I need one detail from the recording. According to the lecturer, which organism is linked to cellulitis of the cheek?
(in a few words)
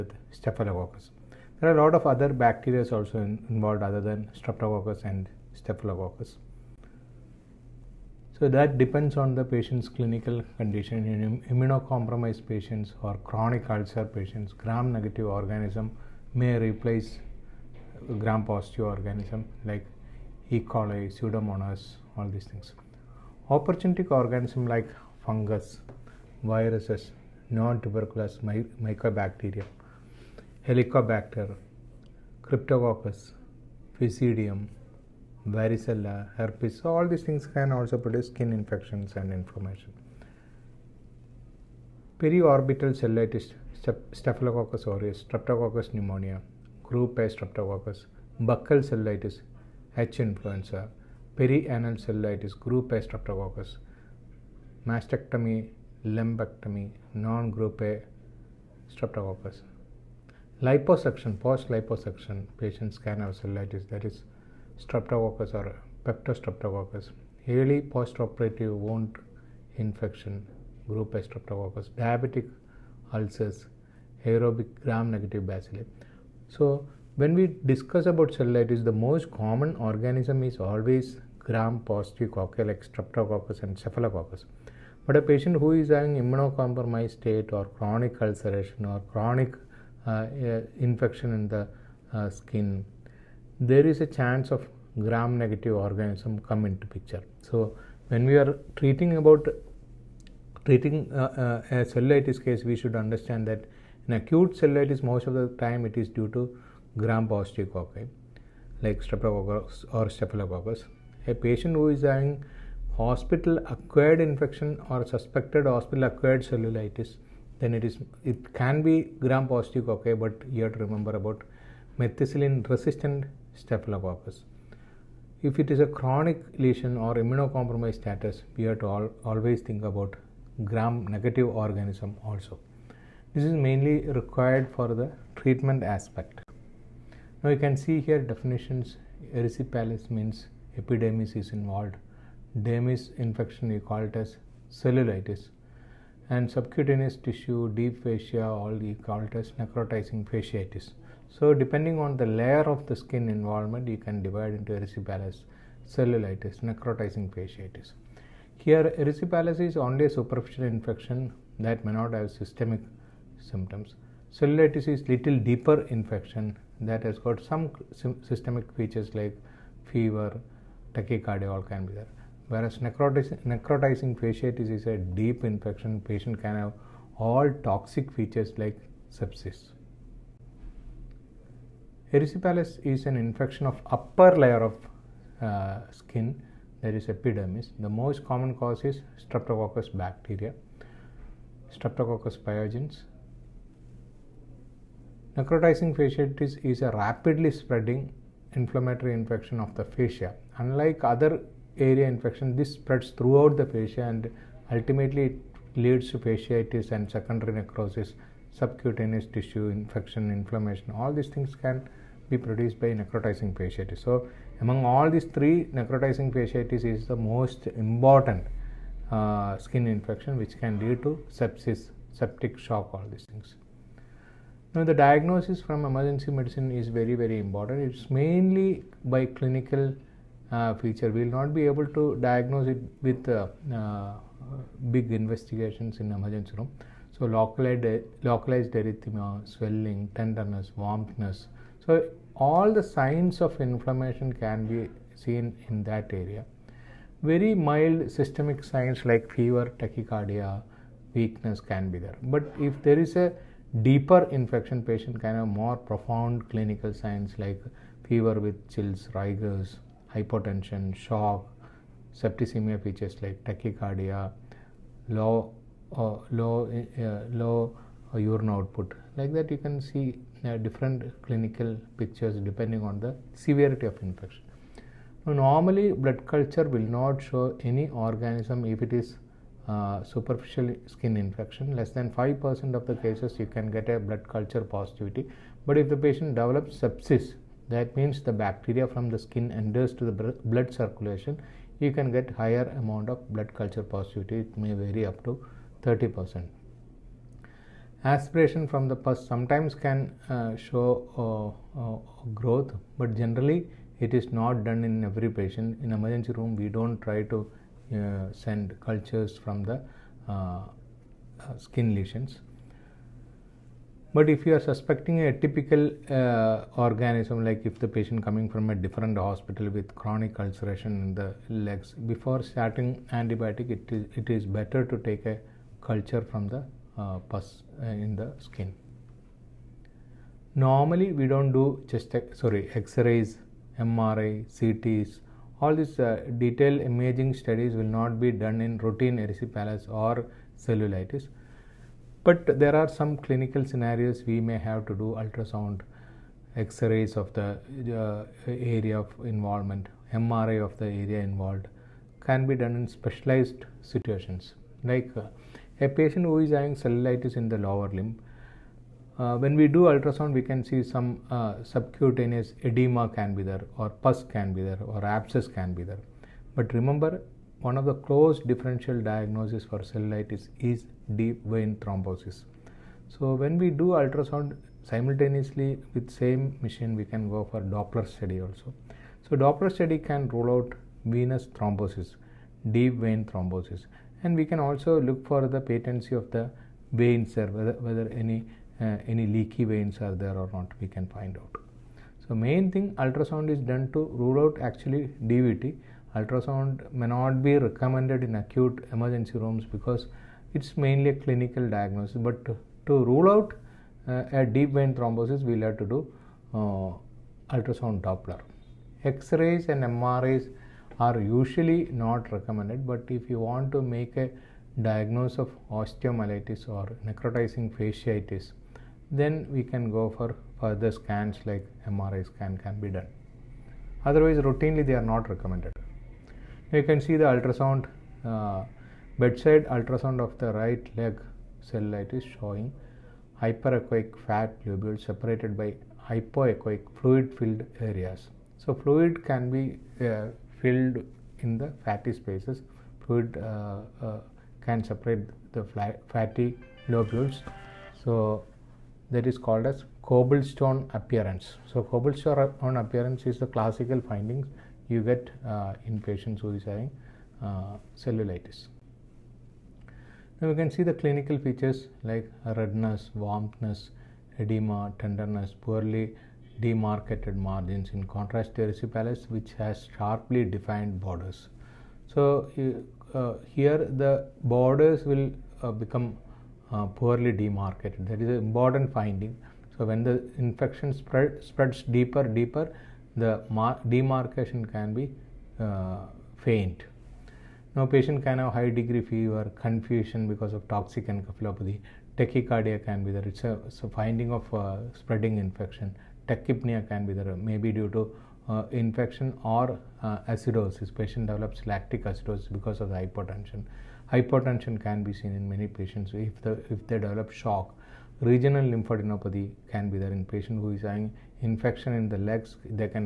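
H influenza.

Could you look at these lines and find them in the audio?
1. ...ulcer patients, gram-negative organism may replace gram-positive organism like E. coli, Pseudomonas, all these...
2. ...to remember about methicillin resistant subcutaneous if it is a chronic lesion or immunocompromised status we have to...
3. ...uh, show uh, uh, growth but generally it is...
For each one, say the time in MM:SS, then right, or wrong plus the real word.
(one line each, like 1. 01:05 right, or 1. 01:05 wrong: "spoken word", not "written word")
1. 00:13 right
2. 02:00 wrong: "staphylococcus", not "subcutaneous"
3. 05:00 right.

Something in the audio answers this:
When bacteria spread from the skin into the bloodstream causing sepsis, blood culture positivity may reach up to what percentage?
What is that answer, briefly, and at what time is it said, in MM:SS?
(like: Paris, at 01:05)
30%, at 04:55.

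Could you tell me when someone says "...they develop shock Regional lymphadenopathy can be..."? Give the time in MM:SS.
08:26.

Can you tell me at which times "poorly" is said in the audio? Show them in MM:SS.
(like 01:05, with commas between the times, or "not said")
07:45, 07:56.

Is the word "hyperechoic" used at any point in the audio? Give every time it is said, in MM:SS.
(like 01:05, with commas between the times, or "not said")
07:13.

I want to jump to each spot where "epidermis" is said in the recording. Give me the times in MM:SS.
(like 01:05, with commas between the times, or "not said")
02:20, 03:07.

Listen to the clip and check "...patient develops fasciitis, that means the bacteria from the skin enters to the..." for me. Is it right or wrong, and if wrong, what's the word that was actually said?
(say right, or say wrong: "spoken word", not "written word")
wrong: "sepsis", not "fasciitis".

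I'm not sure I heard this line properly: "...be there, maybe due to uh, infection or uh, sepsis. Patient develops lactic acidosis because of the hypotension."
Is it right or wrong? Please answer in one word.
wrong.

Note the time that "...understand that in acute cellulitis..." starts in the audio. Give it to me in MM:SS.
01:42.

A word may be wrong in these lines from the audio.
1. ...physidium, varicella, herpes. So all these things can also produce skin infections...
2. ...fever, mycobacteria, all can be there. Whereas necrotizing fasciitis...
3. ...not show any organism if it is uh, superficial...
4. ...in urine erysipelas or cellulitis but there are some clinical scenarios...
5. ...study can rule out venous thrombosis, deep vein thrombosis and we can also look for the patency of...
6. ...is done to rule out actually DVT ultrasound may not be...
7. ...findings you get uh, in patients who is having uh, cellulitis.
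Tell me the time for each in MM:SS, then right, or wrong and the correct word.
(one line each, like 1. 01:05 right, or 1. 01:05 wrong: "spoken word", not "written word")
1. 00:33 right
2. 02:49 wrong: "tachycardia", not "mycobacteria"
3. 04:36 right
4. 05:38 wrong: "routine", not "urine"
5. 06:19 right
6. 06:33 right
7. 07:34 right.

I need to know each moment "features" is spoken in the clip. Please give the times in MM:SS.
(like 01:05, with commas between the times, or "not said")
02:48, 02:58, 03:50, 04:22, 07:41.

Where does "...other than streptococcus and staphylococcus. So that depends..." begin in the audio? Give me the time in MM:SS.
00:03.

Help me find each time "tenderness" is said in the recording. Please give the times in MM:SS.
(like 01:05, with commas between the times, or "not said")
04:00, 07:44.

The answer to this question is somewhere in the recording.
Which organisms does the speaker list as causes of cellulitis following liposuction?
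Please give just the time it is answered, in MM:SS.
01:04.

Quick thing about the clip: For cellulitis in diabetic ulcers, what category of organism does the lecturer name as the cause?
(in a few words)
Aerobic gram-negative bacilli.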